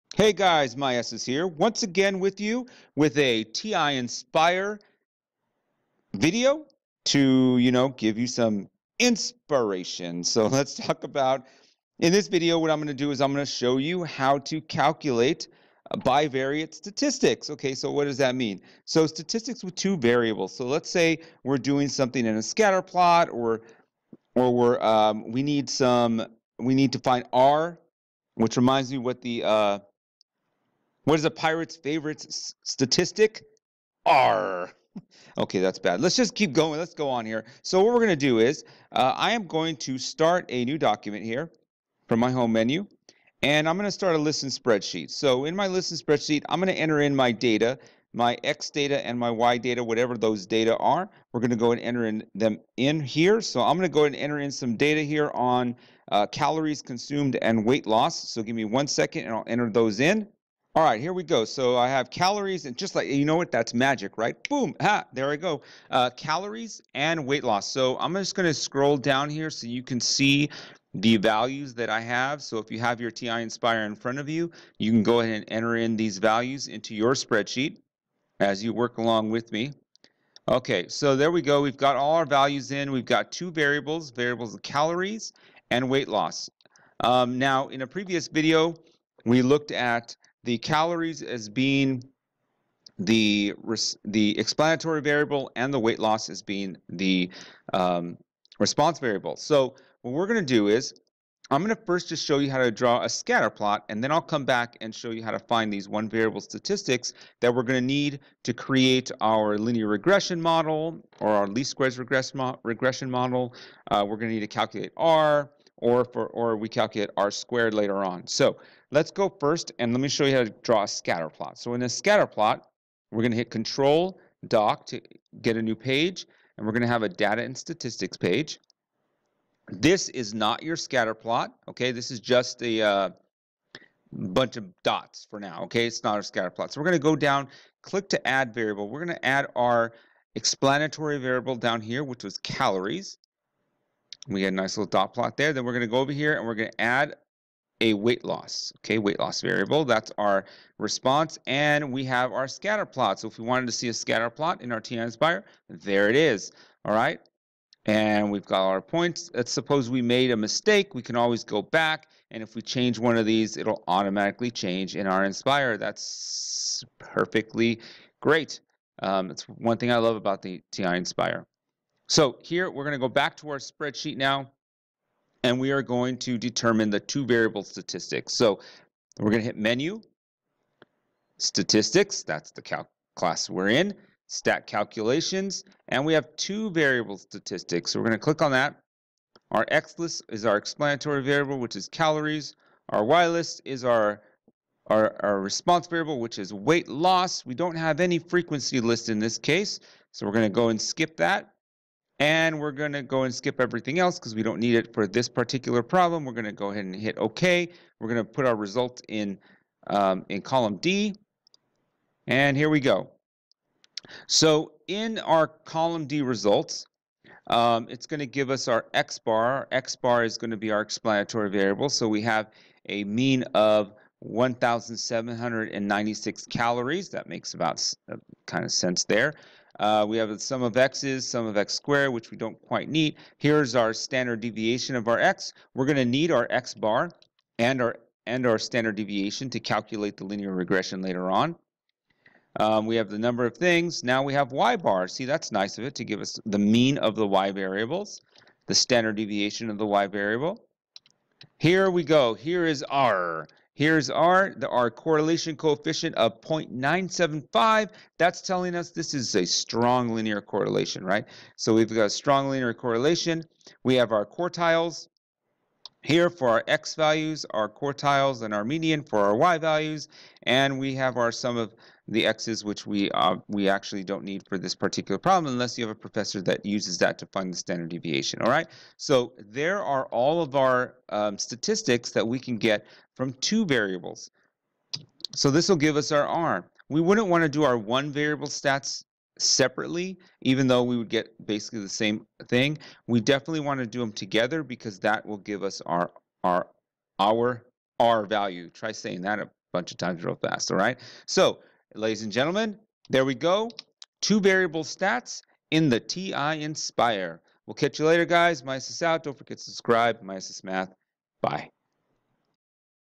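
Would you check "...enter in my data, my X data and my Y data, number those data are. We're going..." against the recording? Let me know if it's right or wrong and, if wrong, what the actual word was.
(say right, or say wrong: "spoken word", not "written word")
wrong: "whatever", not "number".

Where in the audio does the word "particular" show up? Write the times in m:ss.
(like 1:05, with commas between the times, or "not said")
3:25, 4:34.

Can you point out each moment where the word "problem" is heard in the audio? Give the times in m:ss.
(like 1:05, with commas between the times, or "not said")
3:25, 4:35.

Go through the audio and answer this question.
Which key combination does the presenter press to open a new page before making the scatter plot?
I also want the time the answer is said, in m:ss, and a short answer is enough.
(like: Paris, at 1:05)
Control Doc, at 2:03.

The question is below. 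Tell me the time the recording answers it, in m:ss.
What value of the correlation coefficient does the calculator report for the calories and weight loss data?
4:16.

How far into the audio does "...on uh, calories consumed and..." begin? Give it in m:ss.
0:55.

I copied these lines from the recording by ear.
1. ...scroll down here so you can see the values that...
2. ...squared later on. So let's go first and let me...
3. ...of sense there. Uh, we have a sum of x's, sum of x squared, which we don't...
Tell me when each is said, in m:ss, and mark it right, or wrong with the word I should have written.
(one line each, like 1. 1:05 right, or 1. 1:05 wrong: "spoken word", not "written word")
1. 1:08 right
2. 1:57 right
3. 3:48 right.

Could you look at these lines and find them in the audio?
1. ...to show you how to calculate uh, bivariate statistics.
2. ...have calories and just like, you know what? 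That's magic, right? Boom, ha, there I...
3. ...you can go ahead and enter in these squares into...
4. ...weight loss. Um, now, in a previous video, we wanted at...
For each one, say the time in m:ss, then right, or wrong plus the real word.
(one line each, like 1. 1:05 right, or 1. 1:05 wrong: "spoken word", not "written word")
1. 0:13 right
2. 1:01 right
3. 1:14 wrong: "values", not "squares"
4. 1:25 wrong: "looked", not "wanted".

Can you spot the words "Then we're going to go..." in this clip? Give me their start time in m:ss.
2:25.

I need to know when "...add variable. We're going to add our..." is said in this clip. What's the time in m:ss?
2:18.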